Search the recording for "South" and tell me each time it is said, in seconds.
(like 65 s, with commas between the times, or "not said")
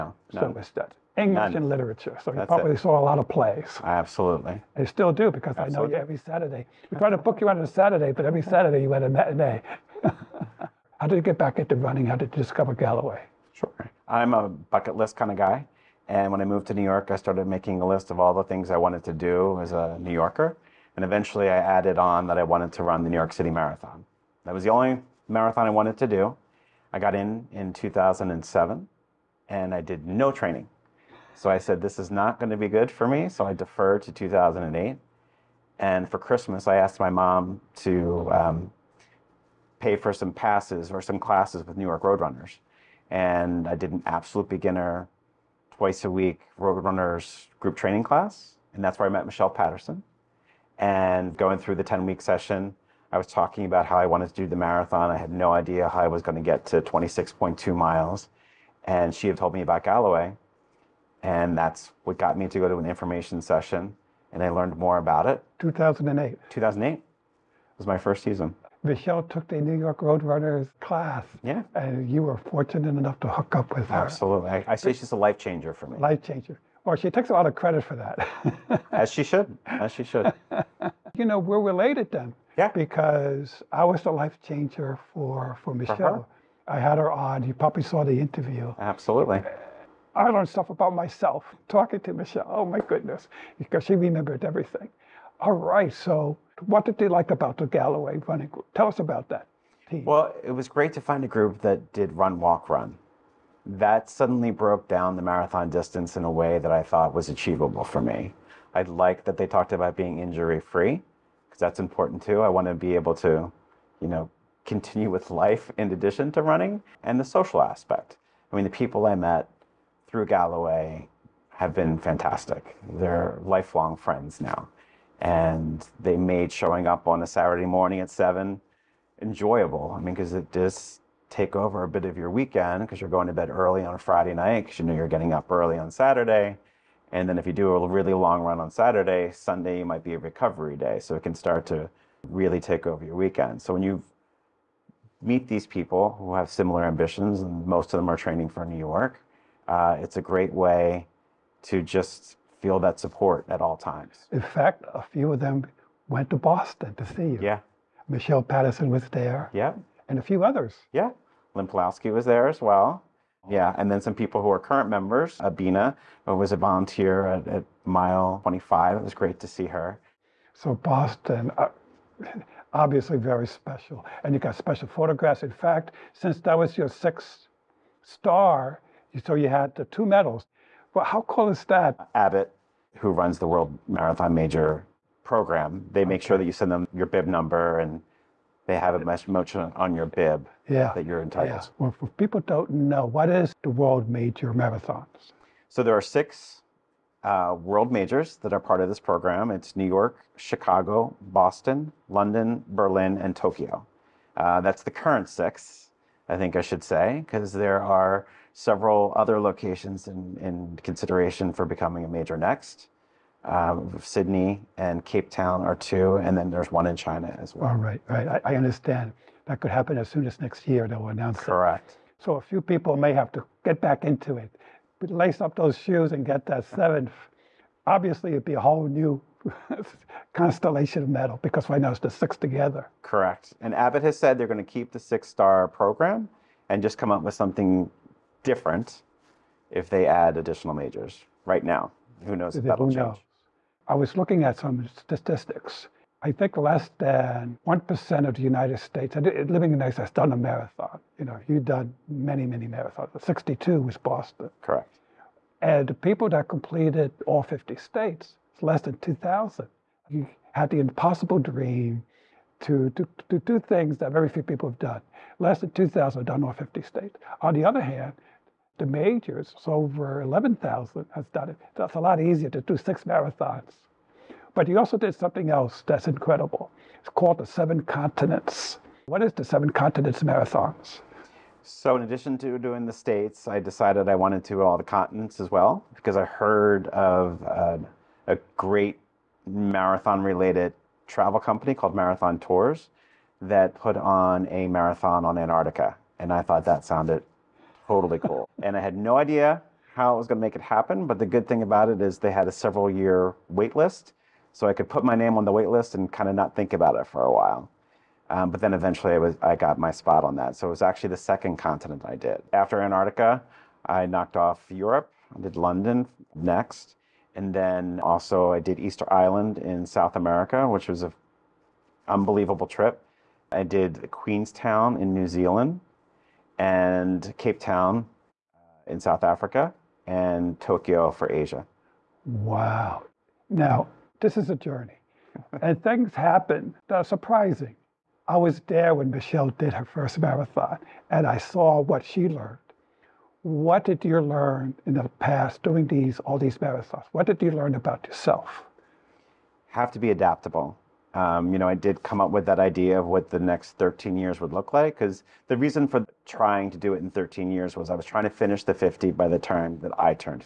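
319 s, 329 s.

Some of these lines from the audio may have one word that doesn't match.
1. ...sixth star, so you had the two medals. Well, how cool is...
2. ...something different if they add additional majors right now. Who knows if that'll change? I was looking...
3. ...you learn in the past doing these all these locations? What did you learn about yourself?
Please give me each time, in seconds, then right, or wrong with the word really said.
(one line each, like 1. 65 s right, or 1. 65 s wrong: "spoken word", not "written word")
1. 176 s right
2. 237 s right
3. 344 s wrong: "marathons", not "locations".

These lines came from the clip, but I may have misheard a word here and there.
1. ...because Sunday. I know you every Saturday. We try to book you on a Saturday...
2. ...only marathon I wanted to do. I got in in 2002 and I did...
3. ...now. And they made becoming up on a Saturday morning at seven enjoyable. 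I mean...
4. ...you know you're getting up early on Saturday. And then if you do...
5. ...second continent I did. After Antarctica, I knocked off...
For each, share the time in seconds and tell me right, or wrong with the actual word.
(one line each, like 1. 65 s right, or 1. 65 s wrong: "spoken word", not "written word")
1. 5 s wrong: "Absolutely", not "Sunday"
2. 24 s wrong: "2007", not "2002"
3. 124 s wrong: "showing", not "becoming"
4. 134 s right
5. 311 s right.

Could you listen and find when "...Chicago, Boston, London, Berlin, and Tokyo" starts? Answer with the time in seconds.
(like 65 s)
200 s.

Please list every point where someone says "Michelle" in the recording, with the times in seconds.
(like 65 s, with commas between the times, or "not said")
49 s, 68 s, 85 s, 92 s, 158 s, 339 s.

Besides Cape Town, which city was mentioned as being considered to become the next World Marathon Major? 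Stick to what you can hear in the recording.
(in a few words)
Sydney.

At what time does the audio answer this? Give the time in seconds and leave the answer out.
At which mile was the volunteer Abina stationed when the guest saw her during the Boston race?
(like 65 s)
167 s.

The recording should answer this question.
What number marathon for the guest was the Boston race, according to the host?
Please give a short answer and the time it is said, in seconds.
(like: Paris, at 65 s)
62, at 253 s.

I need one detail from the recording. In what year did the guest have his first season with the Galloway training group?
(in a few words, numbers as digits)
2008.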